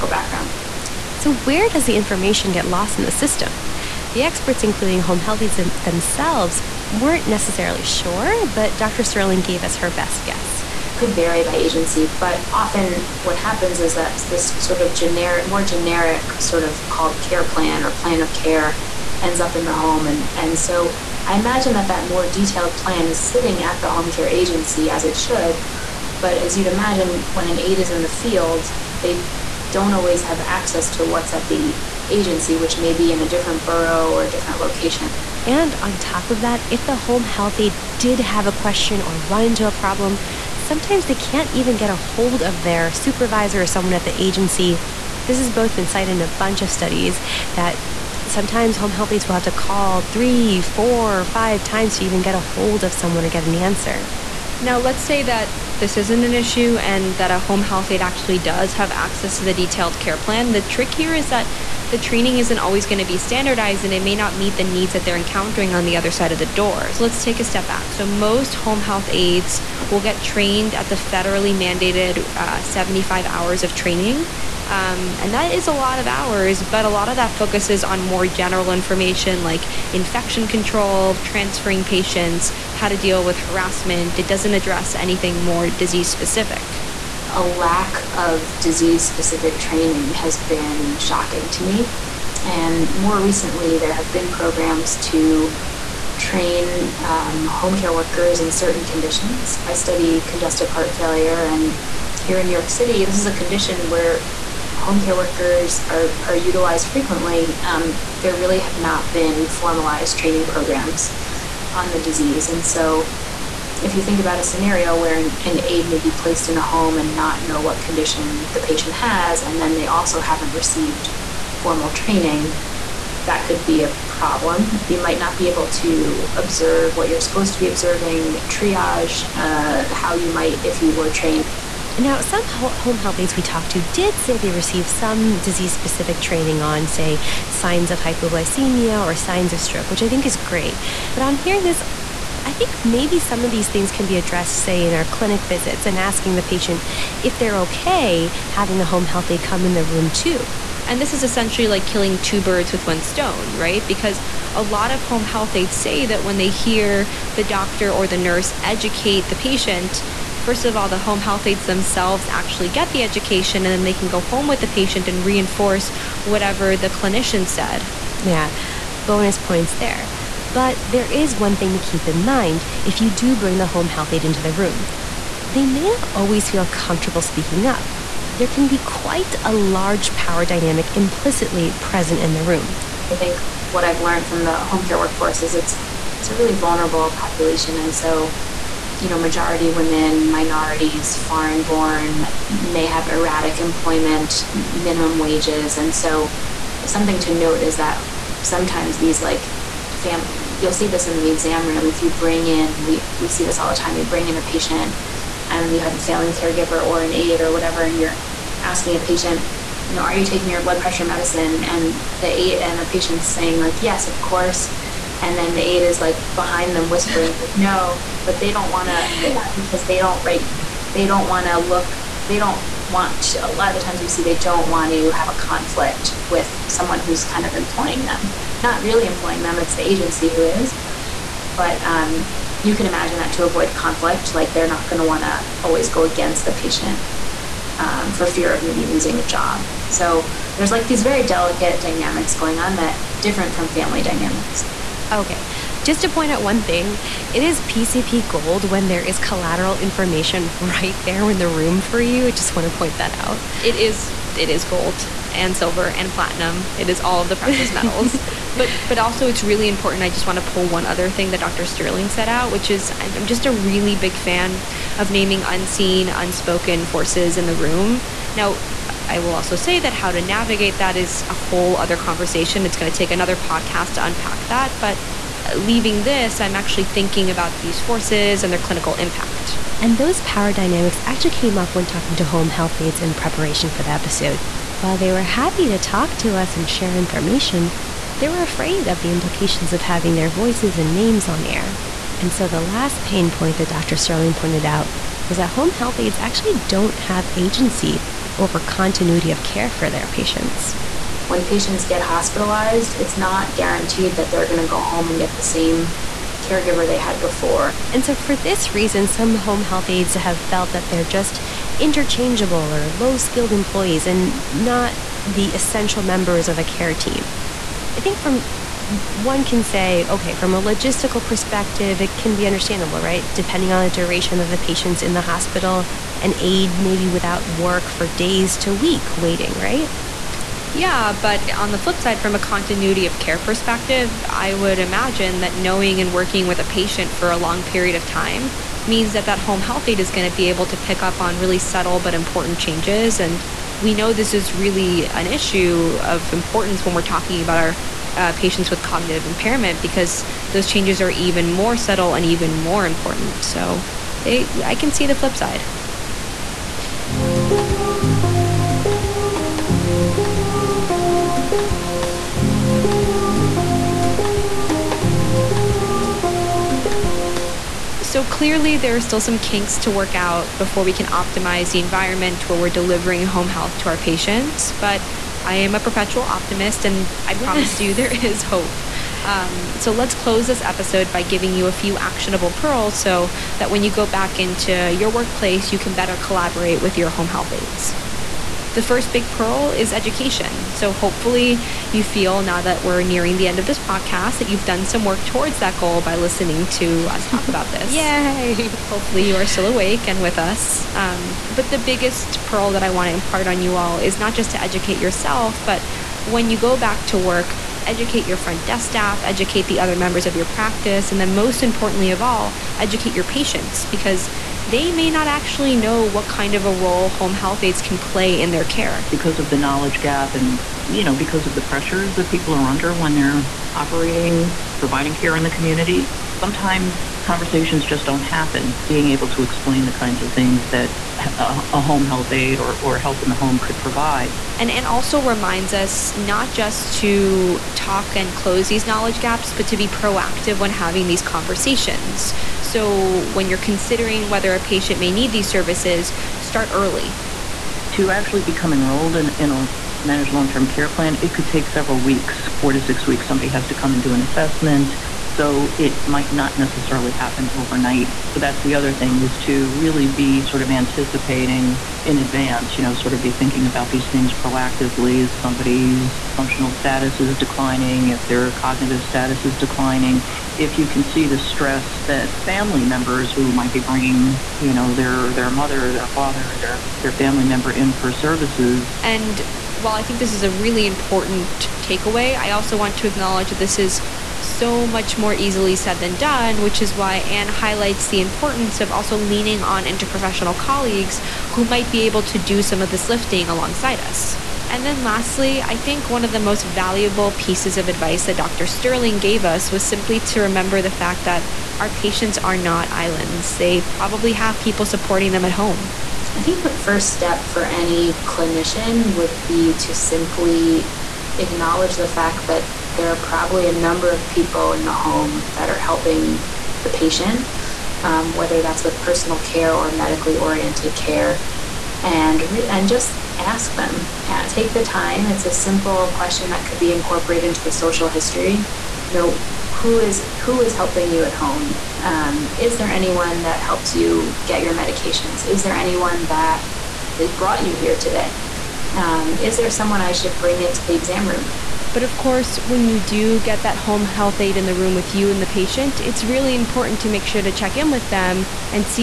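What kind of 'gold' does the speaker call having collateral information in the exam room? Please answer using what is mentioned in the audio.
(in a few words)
PCP gold.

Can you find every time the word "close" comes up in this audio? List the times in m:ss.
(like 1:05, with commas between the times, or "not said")
6:20, 7:18.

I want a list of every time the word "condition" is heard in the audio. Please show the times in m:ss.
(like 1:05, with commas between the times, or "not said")
1:38, 1:43, 1:57.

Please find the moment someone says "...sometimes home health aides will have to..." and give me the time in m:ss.
0:48.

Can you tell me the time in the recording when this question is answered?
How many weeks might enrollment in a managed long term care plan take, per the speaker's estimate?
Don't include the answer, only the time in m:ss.
7:32.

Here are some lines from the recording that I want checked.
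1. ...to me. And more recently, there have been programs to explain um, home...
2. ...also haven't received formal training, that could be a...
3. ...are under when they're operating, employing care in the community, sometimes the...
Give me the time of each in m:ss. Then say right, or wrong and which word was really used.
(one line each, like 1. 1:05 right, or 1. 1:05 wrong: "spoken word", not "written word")
1. 1:31 wrong: "train", not "explain"
2. 1:59 right
3. 7:02 wrong: "providing", not "employing".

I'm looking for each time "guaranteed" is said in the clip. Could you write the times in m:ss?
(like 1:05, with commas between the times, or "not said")
5:03.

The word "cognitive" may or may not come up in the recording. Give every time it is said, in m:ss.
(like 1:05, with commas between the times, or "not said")
5:48, 7:48.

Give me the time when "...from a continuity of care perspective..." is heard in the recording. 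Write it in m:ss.
5:32.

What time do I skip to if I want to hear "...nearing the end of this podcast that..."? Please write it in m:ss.
6:33.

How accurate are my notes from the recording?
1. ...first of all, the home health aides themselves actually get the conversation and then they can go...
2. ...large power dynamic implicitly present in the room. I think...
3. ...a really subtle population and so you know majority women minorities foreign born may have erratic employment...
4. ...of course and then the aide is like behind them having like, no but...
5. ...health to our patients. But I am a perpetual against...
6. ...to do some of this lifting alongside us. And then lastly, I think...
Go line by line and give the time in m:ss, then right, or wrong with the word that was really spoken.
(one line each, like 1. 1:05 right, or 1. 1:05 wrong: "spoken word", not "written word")
1. 2:40 wrong: "education", not "conversation"
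2. 2:59 right
3. 3:06 wrong: "vulnerable", not "subtle"
4. 3:34 wrong: "whispering", not "having"
5. 6:13 wrong: "optimist", not "against"
6. 8:12 right.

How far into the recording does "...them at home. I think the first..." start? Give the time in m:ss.
8:25.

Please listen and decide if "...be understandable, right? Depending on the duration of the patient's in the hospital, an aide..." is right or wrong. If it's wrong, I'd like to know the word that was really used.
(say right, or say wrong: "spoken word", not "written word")
right.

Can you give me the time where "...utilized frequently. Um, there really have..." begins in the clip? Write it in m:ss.
1:46.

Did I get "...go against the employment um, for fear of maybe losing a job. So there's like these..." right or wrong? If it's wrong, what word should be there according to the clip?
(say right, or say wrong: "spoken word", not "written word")
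wrong: "patient", not "employment".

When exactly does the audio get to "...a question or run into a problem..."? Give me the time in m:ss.
0:38.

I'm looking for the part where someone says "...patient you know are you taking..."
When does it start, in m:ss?
3:28.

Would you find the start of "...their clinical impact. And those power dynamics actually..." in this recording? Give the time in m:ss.
4:38.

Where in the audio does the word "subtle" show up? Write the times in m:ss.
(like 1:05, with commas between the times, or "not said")
5:41, 5:51.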